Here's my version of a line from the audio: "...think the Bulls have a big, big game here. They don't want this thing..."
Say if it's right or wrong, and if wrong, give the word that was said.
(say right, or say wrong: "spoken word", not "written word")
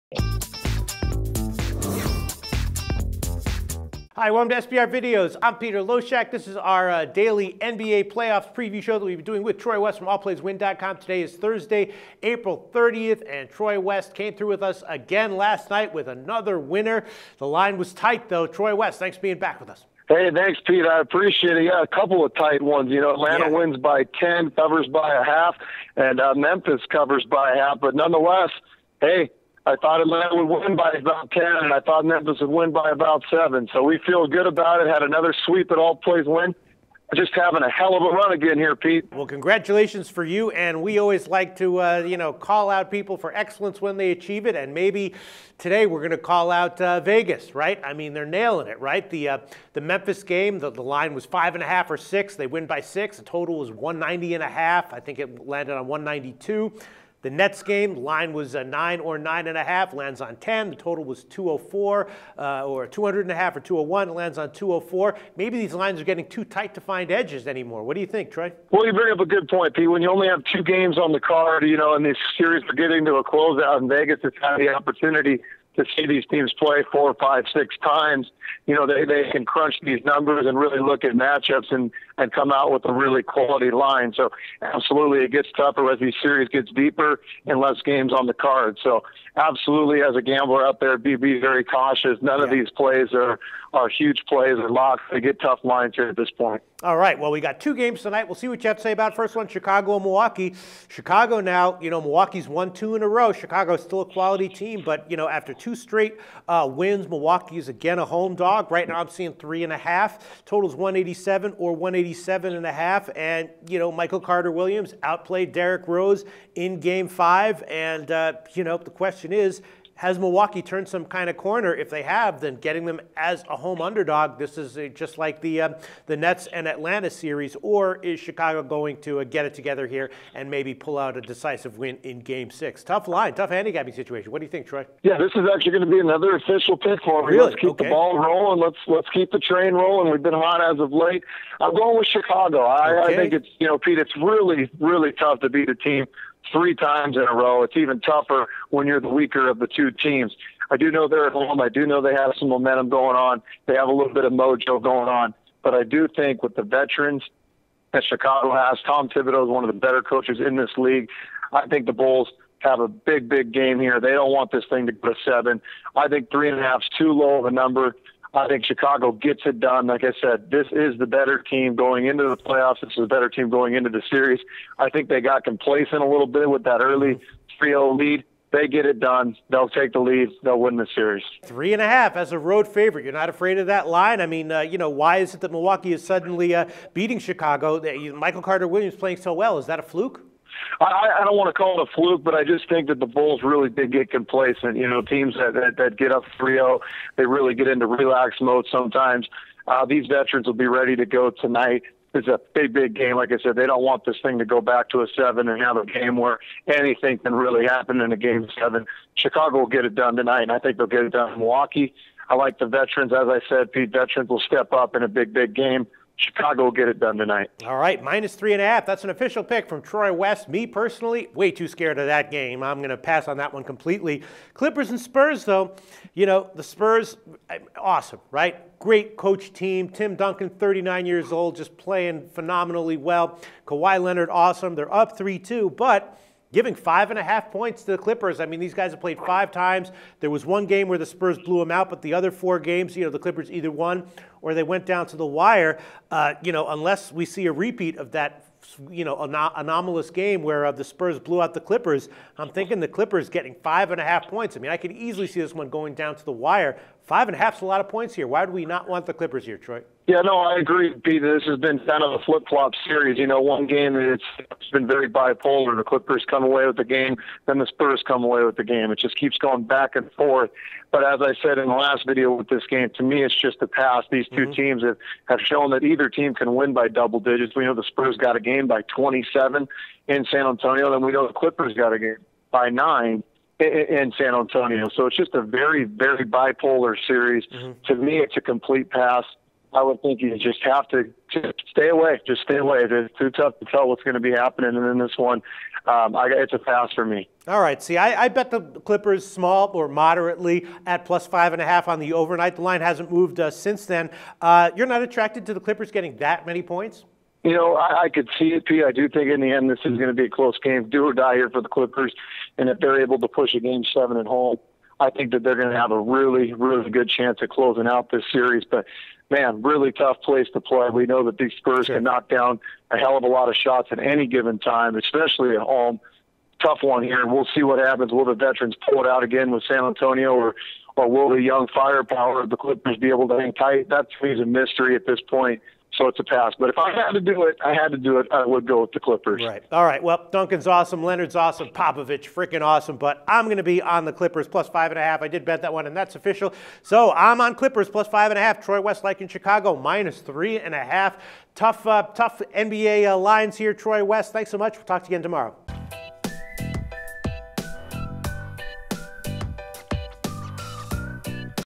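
right.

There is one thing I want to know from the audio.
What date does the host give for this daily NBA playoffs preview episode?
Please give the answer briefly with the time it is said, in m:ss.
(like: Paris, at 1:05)
Thursday, April 30th, at 0:11.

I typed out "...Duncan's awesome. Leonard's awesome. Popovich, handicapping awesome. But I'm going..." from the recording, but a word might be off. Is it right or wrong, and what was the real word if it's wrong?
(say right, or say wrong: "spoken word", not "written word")
wrong: "freaking", not "handicapping".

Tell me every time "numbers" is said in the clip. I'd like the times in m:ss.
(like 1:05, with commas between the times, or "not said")
1:20, 2:47.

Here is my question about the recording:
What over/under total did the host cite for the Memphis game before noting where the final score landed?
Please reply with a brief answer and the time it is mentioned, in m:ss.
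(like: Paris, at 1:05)
190.5, at 0:53.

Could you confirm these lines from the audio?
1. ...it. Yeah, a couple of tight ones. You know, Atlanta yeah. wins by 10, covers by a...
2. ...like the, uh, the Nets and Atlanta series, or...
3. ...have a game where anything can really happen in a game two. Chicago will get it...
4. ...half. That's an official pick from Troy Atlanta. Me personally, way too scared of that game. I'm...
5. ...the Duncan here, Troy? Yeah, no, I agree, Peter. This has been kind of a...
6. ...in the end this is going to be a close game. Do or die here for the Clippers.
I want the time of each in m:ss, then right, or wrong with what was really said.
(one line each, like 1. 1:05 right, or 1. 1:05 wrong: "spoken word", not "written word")
1. 0:21 right
2. 2:05 right
3. 3:25 wrong: "seven", not "two"
4. 3:38 wrong: "West", not "Atlanta"
5. 4:19 wrong: "Clippers", not "Duncan"
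6. 5:09 right.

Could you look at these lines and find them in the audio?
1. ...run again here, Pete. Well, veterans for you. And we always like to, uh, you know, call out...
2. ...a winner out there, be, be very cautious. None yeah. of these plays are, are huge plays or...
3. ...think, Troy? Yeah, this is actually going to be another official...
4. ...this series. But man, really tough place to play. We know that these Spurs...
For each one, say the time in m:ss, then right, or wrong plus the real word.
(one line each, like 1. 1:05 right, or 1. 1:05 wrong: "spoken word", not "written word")
1. 0:38 wrong: "congratulations", not "veterans"
2. 1:30 wrong: "gambler", not "winner"
3. 2:14 right
4. 5:18 right.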